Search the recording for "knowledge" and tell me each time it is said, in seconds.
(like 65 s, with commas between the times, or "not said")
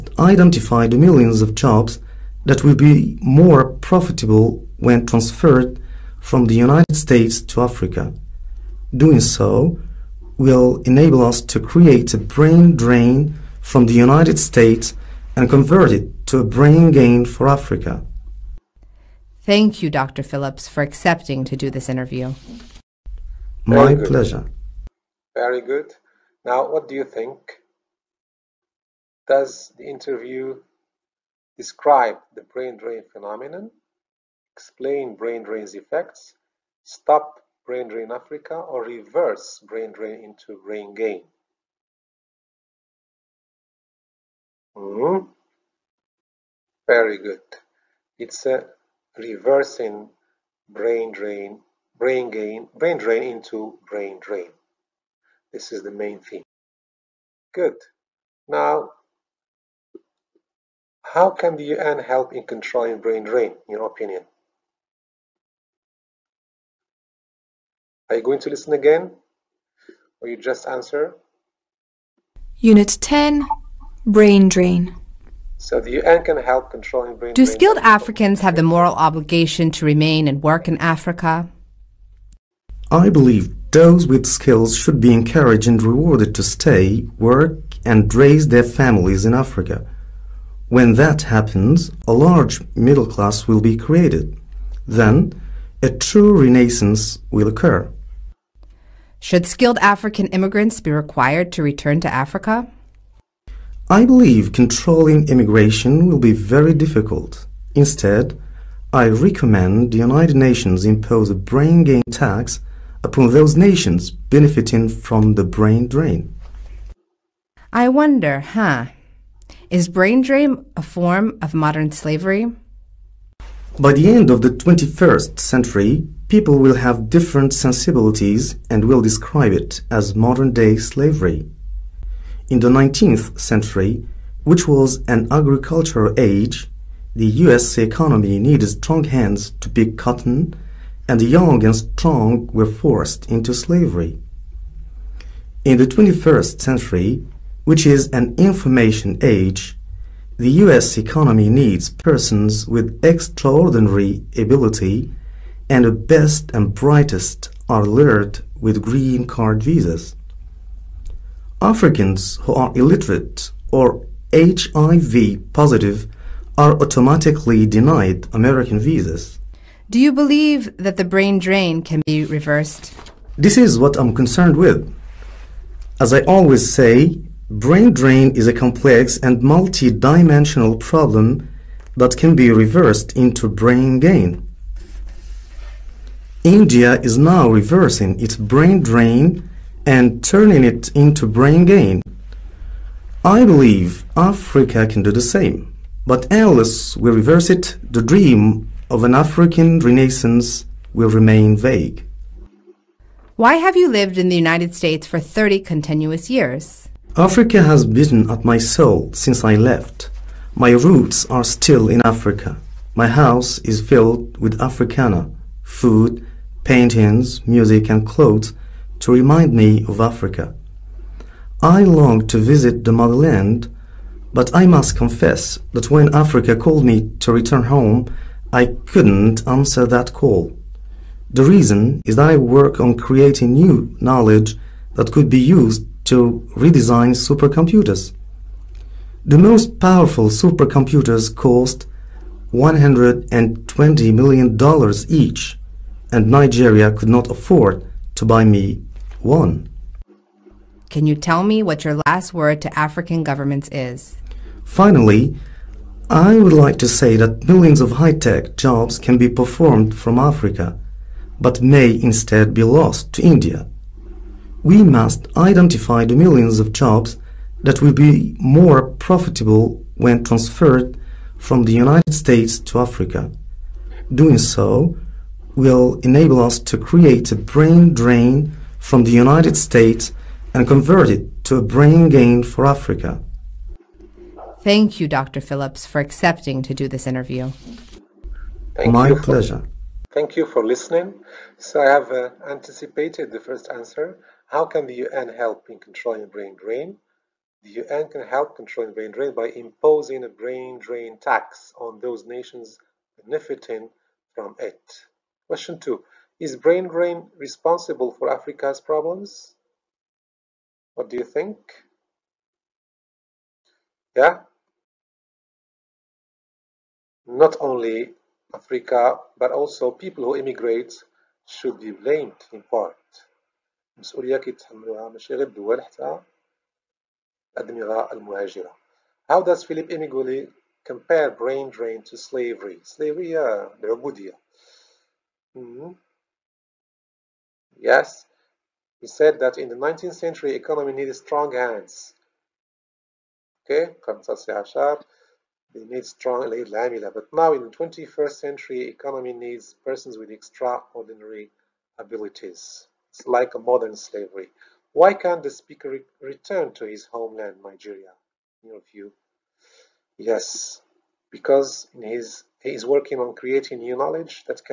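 234 s, 363 s.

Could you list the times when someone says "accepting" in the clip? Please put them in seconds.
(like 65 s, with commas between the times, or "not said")
20 s, 286 s.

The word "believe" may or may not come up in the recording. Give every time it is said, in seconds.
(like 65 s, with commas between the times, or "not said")
83 s, 104 s, 170 s, 193 s.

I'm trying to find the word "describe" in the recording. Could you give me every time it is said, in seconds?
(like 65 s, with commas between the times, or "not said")
31 s, 129 s.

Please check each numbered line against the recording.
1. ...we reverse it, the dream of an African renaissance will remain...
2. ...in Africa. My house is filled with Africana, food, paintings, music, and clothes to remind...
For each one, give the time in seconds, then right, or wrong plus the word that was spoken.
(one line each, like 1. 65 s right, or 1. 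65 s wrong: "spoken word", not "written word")
1. 196 s right
2. 211 s right.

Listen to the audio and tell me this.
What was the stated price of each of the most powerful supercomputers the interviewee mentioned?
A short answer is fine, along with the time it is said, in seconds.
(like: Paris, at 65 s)
$120 million, at 242 s.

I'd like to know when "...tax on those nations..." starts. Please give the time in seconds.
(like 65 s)
301 s.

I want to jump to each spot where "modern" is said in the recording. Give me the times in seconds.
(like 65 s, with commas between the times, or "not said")
121 s, 130 s, 353 s.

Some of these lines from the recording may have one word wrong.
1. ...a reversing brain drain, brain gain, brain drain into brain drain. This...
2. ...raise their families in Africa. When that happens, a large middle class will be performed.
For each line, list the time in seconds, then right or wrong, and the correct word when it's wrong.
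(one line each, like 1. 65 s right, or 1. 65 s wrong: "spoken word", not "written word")
1. 48 s right
2. 88 s wrong: "created", not "performed".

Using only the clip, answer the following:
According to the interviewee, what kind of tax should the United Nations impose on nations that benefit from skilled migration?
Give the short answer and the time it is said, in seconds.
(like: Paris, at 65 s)
brain gain tax, at 111 s.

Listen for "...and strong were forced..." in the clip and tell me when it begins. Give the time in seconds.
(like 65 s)
141 s.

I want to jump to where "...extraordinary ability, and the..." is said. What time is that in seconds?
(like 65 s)
153 s.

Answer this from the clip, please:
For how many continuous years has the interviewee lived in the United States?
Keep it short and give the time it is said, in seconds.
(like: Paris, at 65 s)
30, at 205 s.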